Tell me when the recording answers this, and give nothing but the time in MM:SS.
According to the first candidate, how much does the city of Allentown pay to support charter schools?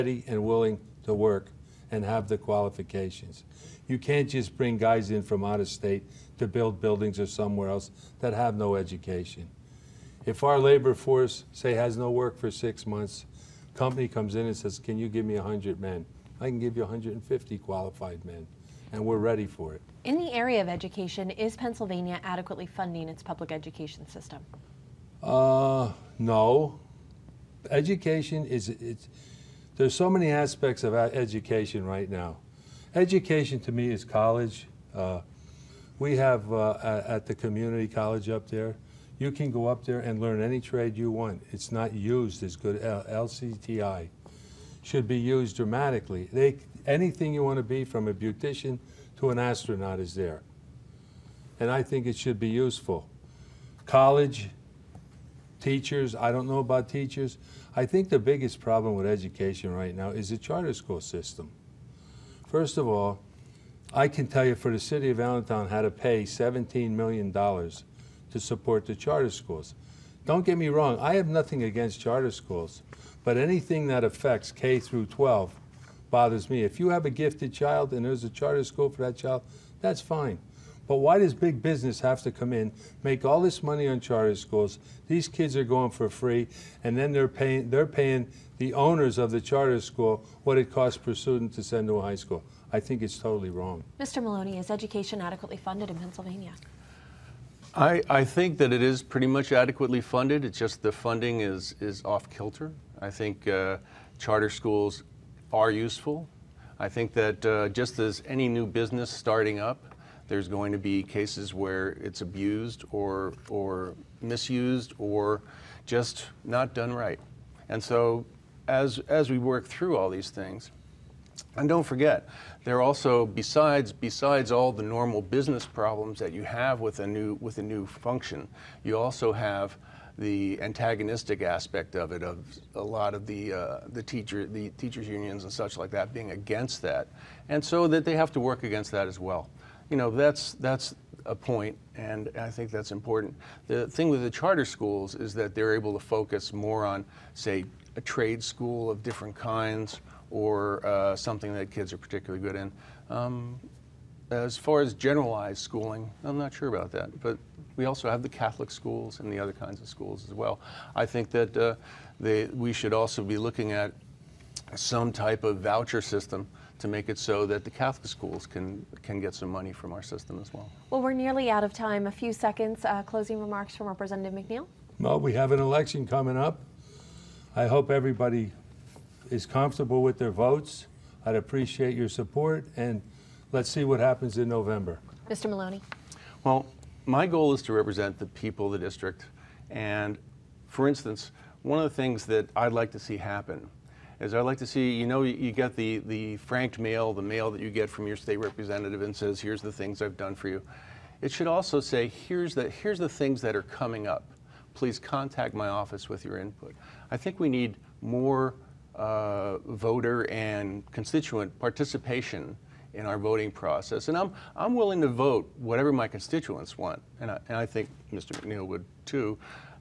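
01:06.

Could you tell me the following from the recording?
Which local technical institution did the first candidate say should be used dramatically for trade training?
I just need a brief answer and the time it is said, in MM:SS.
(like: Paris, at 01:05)
LCTI, at 00:42.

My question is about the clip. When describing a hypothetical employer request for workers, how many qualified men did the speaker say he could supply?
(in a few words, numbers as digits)
150.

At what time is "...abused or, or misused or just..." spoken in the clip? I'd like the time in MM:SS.
01:52.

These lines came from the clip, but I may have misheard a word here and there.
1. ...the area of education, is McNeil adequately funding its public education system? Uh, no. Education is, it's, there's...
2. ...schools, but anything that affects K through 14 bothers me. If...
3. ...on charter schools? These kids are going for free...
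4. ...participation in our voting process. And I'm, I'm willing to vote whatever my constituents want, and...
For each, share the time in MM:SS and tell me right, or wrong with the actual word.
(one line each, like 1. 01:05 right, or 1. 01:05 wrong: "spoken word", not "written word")
1. 00:20 wrong: "Pennsylvania", not "McNeil"
2. 01:12 wrong: "12", not "14"
3. 01:23 right
4. 03:31 right.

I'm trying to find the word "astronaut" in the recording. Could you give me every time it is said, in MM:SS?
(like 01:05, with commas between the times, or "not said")
00:49.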